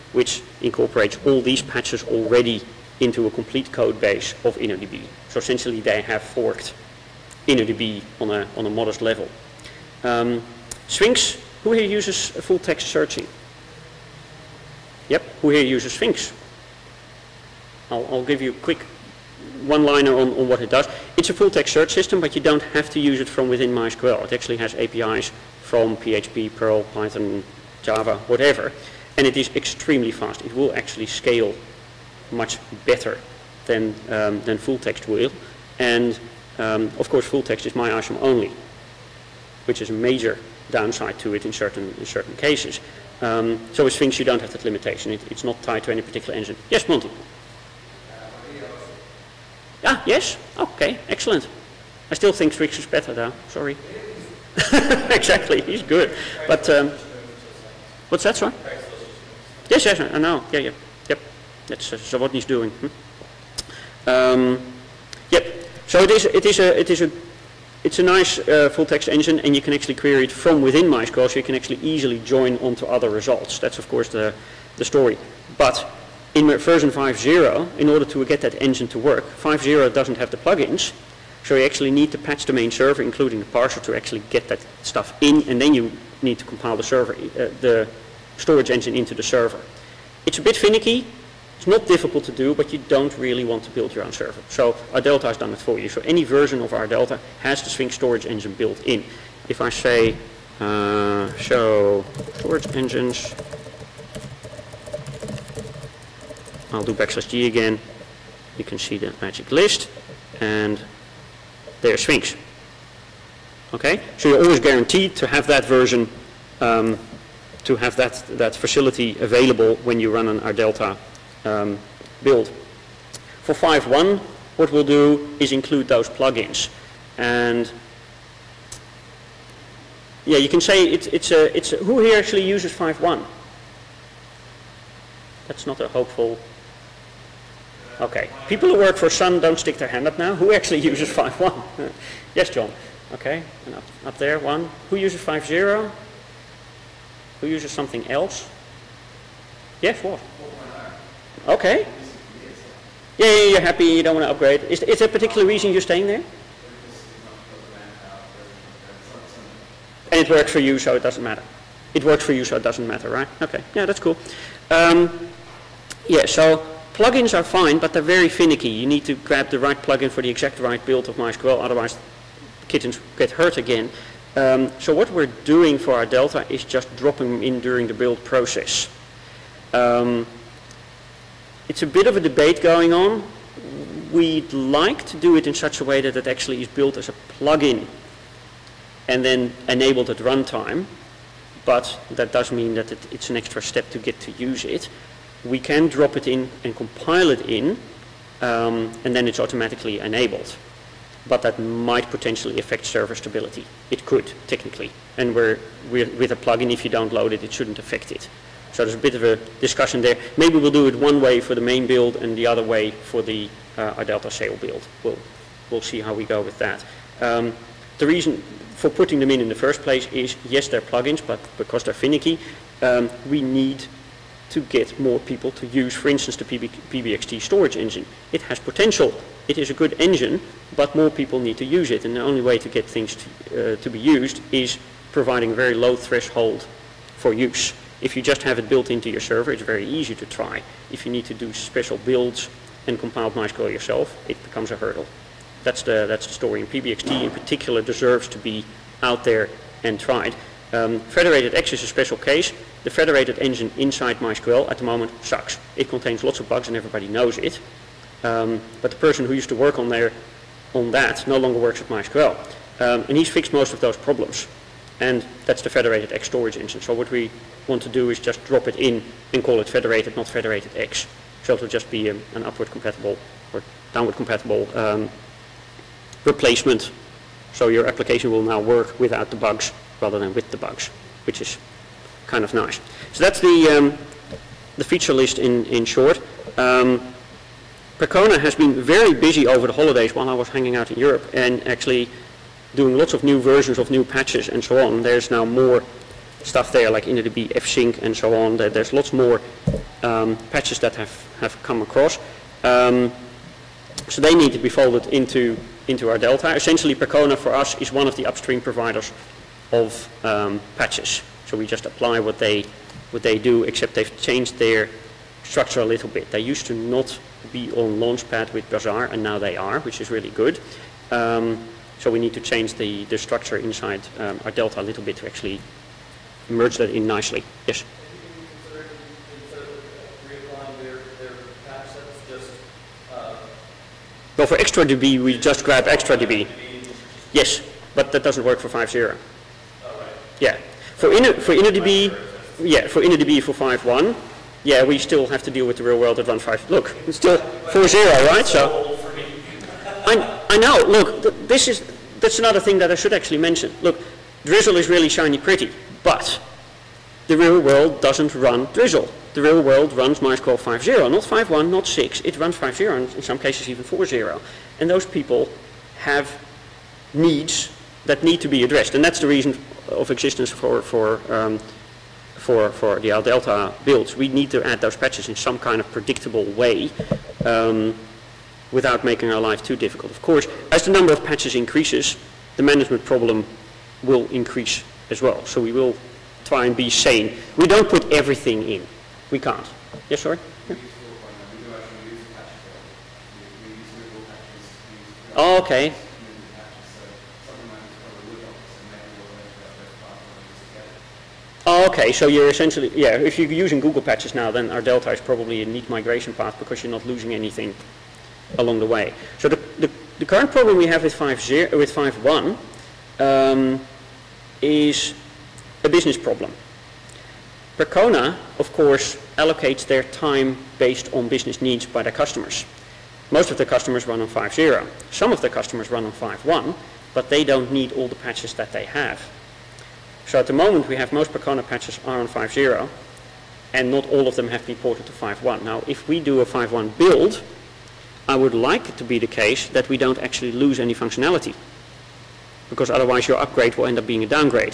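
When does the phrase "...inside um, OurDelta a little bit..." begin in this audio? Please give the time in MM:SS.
05:23.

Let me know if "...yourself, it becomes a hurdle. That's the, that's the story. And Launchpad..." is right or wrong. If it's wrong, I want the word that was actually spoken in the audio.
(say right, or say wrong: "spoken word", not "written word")
wrong: "PBXT", not "Launchpad".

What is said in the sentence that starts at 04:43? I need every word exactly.
So that's the, um, the feature list in, in short.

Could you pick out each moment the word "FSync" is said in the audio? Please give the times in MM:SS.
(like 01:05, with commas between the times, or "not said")
04:57.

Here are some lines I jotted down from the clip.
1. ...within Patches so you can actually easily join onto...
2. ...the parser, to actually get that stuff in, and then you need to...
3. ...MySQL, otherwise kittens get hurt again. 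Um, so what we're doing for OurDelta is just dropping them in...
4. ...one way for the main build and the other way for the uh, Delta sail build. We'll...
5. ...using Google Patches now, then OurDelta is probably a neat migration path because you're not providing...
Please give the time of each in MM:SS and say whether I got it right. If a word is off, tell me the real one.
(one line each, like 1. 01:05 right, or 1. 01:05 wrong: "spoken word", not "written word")
1. 01:10 wrong: "MySQL", not "Patches"
2. 01:23 right
3. 02:51 right
4. 03:30 right
5. 06:43 wrong: "losing", not "providing".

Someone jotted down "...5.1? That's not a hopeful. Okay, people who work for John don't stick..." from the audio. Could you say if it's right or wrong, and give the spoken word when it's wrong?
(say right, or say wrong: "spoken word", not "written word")
wrong: "Sun", not "John".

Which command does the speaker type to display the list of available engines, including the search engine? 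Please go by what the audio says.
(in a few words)
show storage engines.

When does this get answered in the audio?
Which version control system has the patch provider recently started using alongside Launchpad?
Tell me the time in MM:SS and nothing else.
05:18.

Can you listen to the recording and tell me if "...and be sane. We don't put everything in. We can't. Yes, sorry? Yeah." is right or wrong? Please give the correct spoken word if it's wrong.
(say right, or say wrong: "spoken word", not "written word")
right.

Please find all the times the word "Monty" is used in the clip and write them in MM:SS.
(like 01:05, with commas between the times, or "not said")
00:46.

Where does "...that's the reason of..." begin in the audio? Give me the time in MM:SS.
06:09.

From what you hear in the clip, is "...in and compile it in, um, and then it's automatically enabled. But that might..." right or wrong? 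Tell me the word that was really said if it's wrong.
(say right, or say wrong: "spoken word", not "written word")
right.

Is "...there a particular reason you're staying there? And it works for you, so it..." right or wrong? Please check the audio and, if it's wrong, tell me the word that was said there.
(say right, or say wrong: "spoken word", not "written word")
right.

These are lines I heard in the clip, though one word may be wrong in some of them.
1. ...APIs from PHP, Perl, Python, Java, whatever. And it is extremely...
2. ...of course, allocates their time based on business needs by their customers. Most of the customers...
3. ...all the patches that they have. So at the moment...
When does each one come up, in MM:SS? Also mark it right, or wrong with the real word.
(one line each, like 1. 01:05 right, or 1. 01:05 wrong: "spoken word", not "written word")
1. 00:24 right
2. 06:58 right
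3. 07:07 right.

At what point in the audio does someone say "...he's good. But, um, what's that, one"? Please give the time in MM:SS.
00:55.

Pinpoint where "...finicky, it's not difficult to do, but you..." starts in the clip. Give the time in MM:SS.
01:30.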